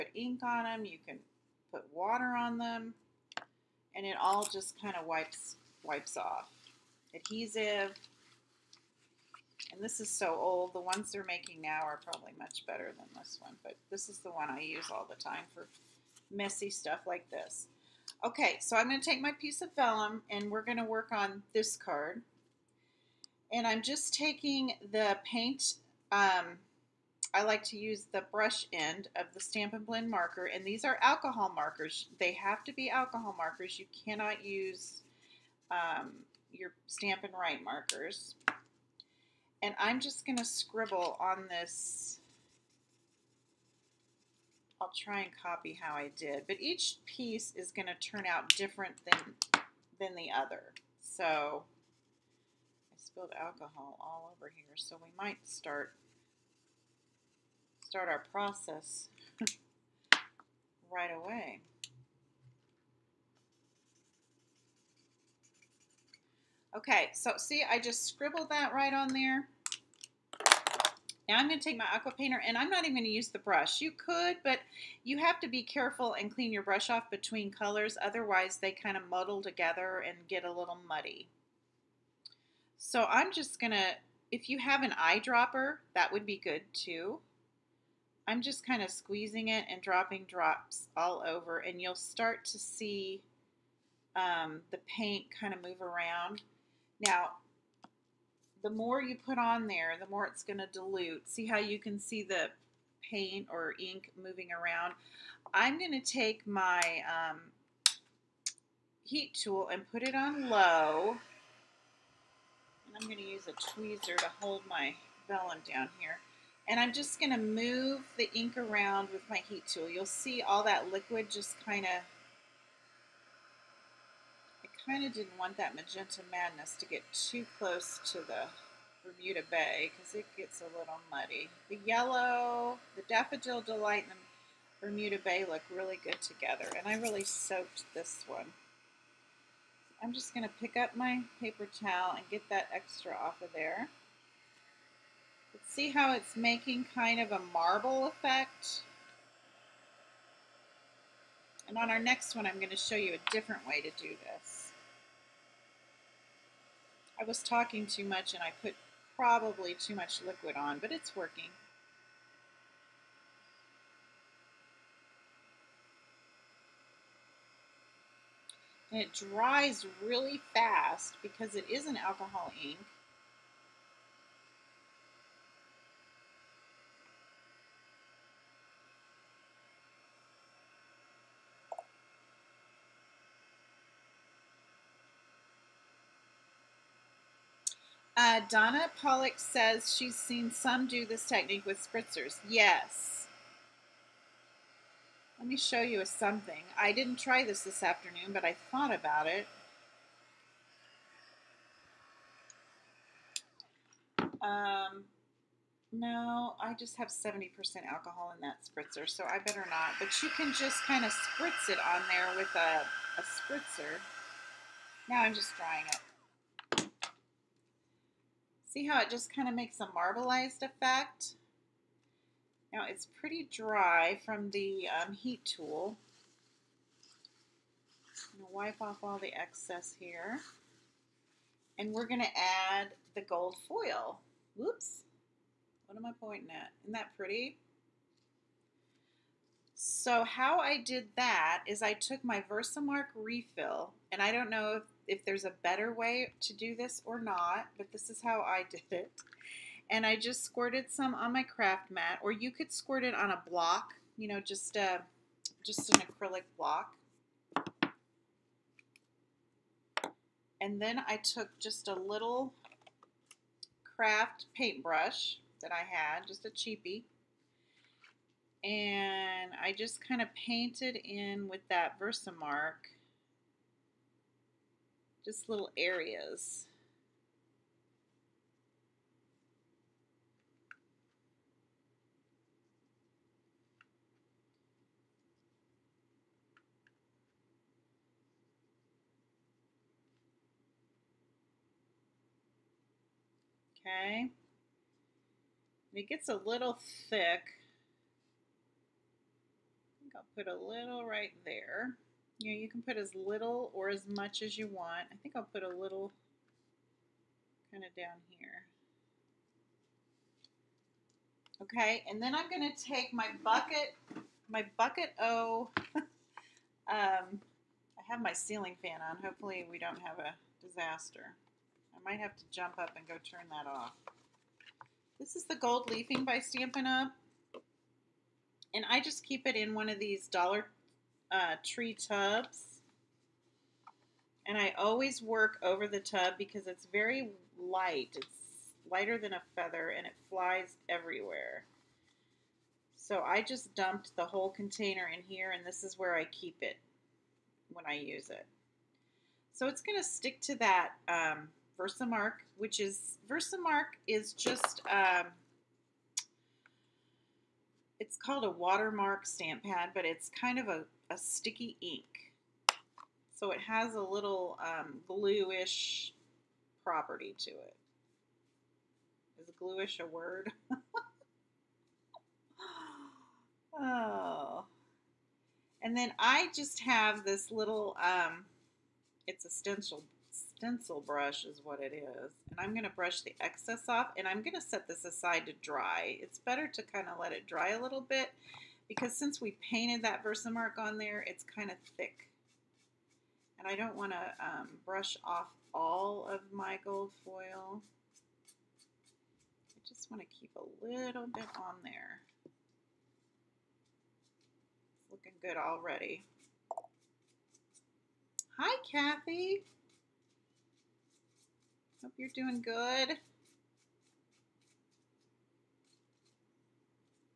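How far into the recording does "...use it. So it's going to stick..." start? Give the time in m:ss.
5:47.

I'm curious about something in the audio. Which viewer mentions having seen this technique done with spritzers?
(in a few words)
Donna Pollock.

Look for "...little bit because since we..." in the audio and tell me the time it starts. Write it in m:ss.
6:27.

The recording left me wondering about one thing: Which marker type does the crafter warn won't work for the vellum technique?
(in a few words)
Stampin' Write markers.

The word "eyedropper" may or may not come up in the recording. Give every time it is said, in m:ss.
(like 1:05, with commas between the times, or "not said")
1:24.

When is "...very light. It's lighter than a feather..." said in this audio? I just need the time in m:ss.
5:36.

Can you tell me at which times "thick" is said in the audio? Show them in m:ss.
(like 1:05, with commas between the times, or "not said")
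4:57, 6:31.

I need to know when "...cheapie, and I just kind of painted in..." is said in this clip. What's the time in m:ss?
4:26.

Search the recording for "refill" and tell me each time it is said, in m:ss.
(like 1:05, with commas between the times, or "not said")
4:03.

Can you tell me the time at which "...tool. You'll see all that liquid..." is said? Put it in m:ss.
1:59.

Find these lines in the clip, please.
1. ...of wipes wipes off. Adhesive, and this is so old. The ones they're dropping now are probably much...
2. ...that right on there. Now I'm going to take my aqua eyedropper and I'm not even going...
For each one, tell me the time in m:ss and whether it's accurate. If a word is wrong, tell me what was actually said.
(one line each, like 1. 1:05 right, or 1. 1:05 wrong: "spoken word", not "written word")
1. 0:04 wrong: "making", not "dropping"
2. 1:08 wrong: "painter", not "eyedropper".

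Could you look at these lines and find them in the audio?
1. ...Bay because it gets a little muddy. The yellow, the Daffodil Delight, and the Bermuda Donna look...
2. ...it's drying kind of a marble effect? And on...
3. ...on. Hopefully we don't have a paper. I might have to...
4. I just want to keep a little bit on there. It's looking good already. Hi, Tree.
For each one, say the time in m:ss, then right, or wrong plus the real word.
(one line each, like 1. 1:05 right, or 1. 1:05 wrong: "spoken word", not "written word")
1. 2:09 wrong: "Bay", not "Donna"
2. 2:26 wrong: "making", not "drying"
3. 5:19 wrong: "disaster", not "paper"
4. 6:39 wrong: "Kathy", not "Tree".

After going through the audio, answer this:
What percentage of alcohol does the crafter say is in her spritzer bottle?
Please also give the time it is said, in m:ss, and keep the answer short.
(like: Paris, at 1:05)
70%, at 3:27.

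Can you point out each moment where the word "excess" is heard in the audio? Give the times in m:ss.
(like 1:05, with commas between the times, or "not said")
3:49, 6:23.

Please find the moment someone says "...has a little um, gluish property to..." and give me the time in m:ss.
6:03.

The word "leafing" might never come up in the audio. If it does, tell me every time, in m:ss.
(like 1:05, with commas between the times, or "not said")
5:25.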